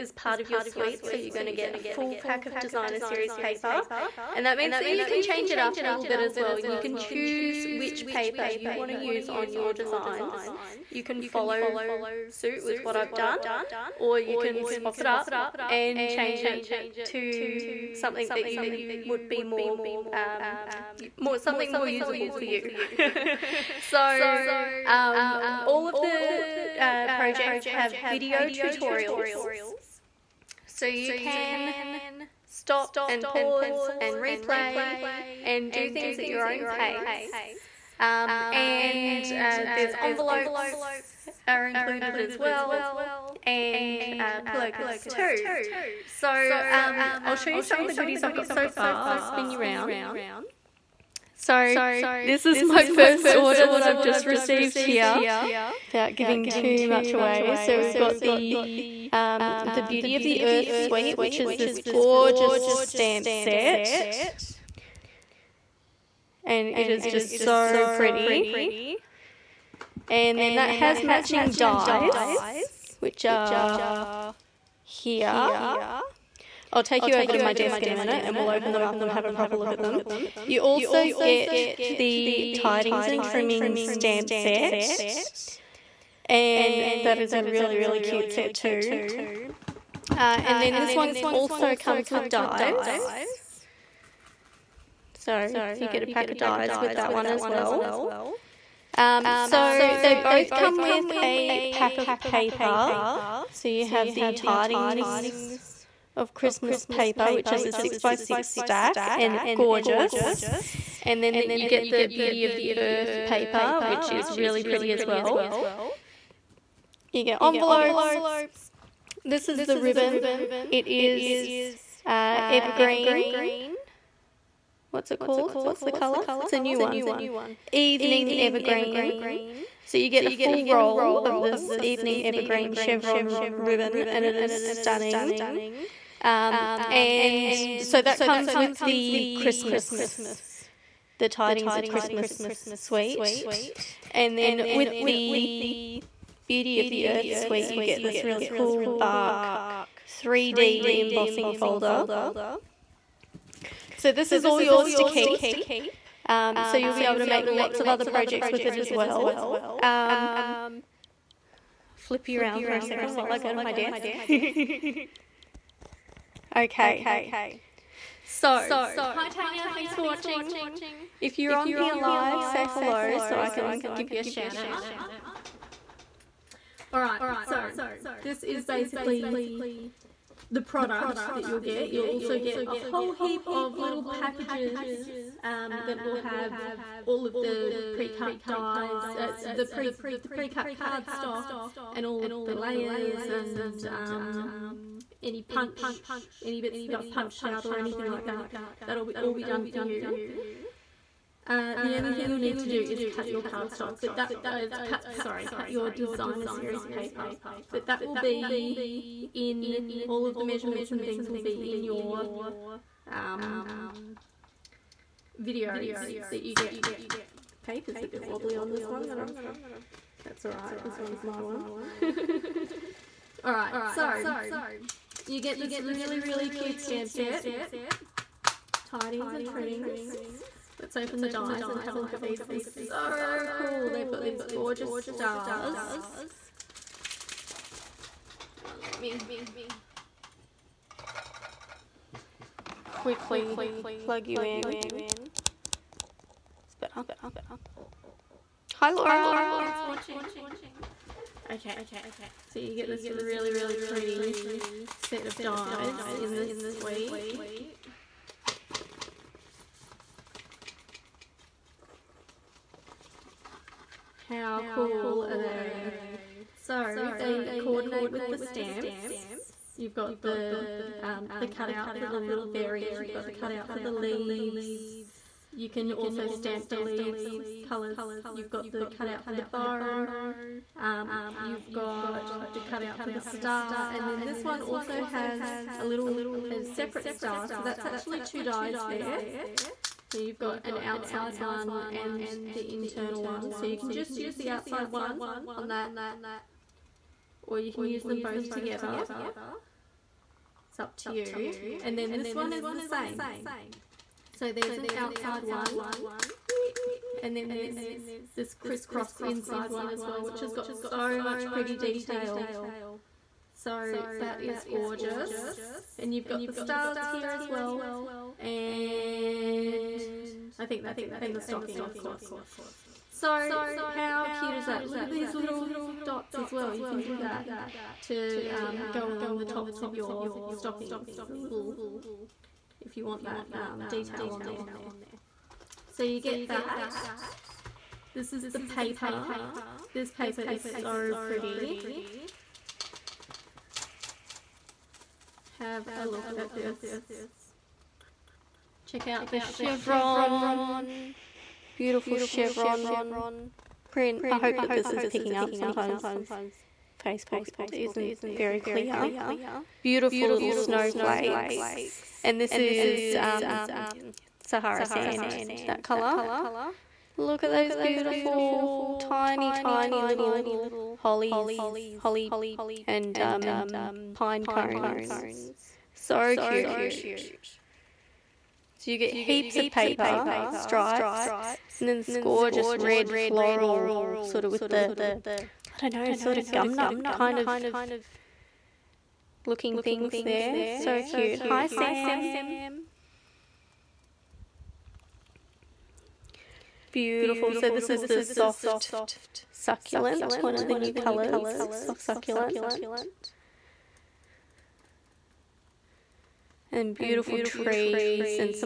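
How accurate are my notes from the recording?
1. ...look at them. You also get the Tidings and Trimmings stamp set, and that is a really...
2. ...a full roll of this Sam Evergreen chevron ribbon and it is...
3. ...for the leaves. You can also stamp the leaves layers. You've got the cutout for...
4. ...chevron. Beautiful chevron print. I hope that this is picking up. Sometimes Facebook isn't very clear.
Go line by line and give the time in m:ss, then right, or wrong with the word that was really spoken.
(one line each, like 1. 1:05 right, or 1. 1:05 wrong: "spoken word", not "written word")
1. 1:19 right
2. 2:10 wrong: "Evening", not "Sam"
3. 4:33 wrong: "colours", not "layers"
4. 5:49 right.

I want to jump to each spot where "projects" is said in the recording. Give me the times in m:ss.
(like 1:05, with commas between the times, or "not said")
0:27, 2:38.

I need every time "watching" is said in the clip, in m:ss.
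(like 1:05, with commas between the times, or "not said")
2:50, 4:09.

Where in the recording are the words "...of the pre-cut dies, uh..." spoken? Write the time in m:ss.
3:07.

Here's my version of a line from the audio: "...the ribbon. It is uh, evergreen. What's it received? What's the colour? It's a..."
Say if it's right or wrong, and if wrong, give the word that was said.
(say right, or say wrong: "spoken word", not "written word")
wrong: "called", not "received".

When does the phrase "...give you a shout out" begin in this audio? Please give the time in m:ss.
2:53.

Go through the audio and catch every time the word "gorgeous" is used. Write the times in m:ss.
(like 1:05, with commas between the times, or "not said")
1:01, 1:49, 3:54, 5:14, 6:22.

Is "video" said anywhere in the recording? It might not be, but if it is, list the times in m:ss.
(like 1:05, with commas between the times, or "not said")
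0:28, 3:35.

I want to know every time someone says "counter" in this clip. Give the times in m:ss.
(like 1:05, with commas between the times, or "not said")
not said.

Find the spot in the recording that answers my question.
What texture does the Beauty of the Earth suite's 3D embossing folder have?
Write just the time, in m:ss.
2:28.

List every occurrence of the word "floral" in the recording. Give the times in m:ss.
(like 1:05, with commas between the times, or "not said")
6:23.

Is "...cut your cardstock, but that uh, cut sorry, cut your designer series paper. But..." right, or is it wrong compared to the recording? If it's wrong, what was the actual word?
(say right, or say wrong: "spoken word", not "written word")
right.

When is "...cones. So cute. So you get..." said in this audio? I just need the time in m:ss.
6:14.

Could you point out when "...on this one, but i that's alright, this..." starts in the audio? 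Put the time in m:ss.
3:38.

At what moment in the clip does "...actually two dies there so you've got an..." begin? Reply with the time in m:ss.
4:47.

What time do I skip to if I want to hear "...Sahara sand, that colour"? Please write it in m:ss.
6:04.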